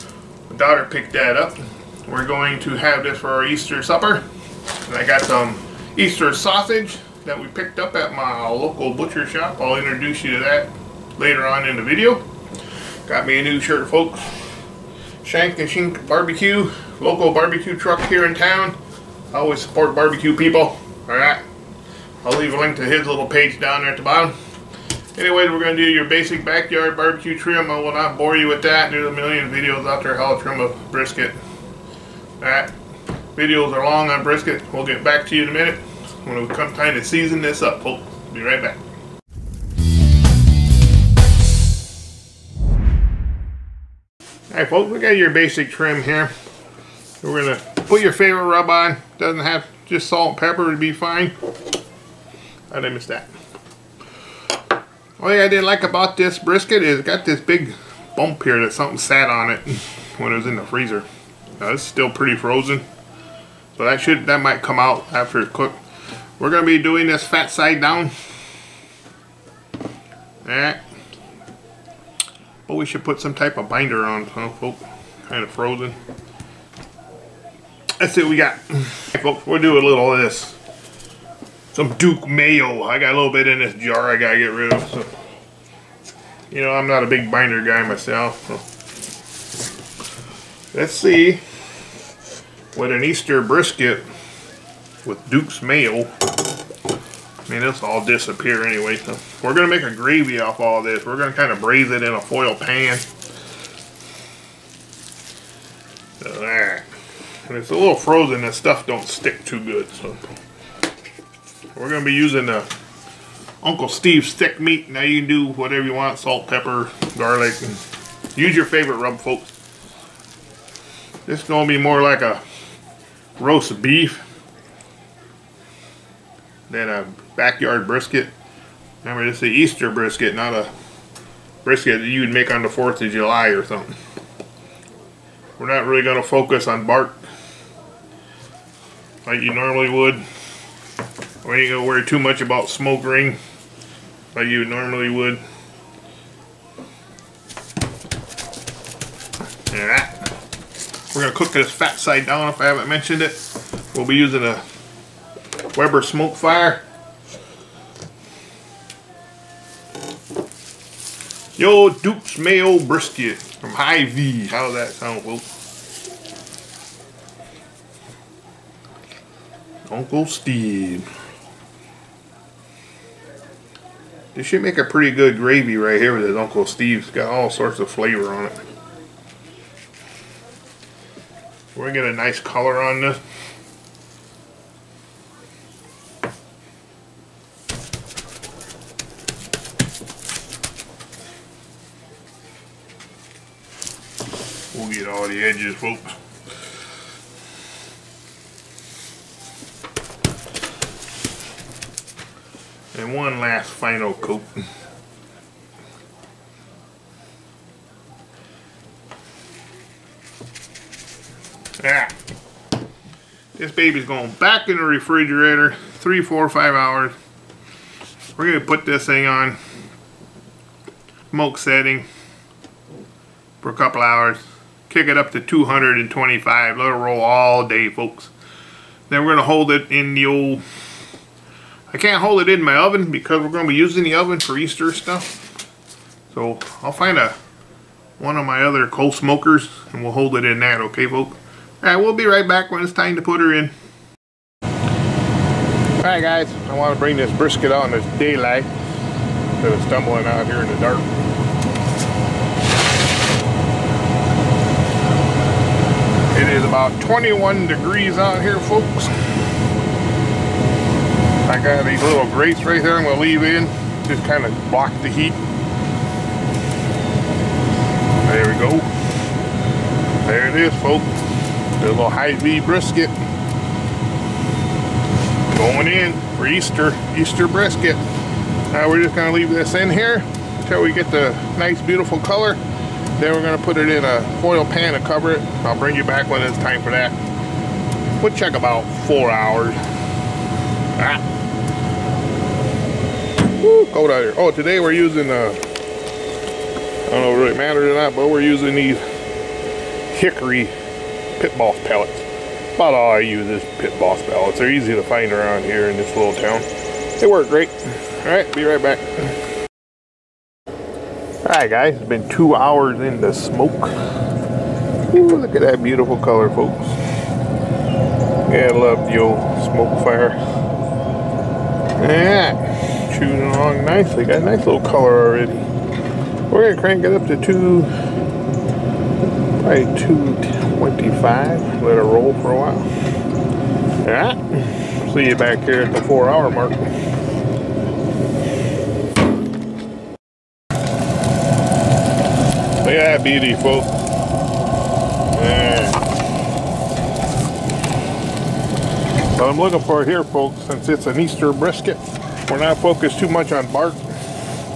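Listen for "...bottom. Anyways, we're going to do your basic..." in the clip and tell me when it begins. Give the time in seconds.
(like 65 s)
24 s.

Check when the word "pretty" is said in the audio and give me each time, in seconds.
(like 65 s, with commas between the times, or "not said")
62 s, 174 s.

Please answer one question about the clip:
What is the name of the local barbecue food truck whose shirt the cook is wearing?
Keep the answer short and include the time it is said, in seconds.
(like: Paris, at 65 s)
Shank and Shink Barbecue, at 15 s.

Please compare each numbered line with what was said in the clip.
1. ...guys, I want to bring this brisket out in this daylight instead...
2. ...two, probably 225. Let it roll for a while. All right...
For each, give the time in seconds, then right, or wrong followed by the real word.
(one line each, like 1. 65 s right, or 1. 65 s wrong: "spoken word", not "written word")
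1. 246 s right
2. 327 s right.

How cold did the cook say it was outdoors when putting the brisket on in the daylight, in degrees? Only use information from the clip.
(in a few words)
21.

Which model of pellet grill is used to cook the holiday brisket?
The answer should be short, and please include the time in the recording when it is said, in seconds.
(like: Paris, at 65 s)
Weber SmokeFire, at 155 s.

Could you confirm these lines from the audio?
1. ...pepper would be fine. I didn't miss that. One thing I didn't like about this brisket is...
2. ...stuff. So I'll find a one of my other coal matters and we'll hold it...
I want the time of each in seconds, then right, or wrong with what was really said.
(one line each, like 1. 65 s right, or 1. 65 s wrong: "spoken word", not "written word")
1. 50 s right
2. 234 s wrong: "smokers", not "matters".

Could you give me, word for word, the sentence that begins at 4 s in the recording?
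And I got some Easter sausage that we picked up at my local butcher shop.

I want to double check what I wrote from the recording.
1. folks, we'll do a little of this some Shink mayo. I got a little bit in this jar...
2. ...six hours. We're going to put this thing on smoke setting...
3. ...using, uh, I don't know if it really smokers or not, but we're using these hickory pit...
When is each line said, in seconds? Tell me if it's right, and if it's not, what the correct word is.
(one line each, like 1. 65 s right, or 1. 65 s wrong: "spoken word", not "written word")
1. 78 s wrong: "Duke", not "Shink"
2. 216 s wrong: "five", not "six"
3. 294 s wrong: "matters", not "smokers".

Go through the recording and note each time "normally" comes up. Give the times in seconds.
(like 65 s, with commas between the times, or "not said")
139 s, 144 s.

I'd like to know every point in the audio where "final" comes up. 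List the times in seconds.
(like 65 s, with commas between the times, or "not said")
203 s.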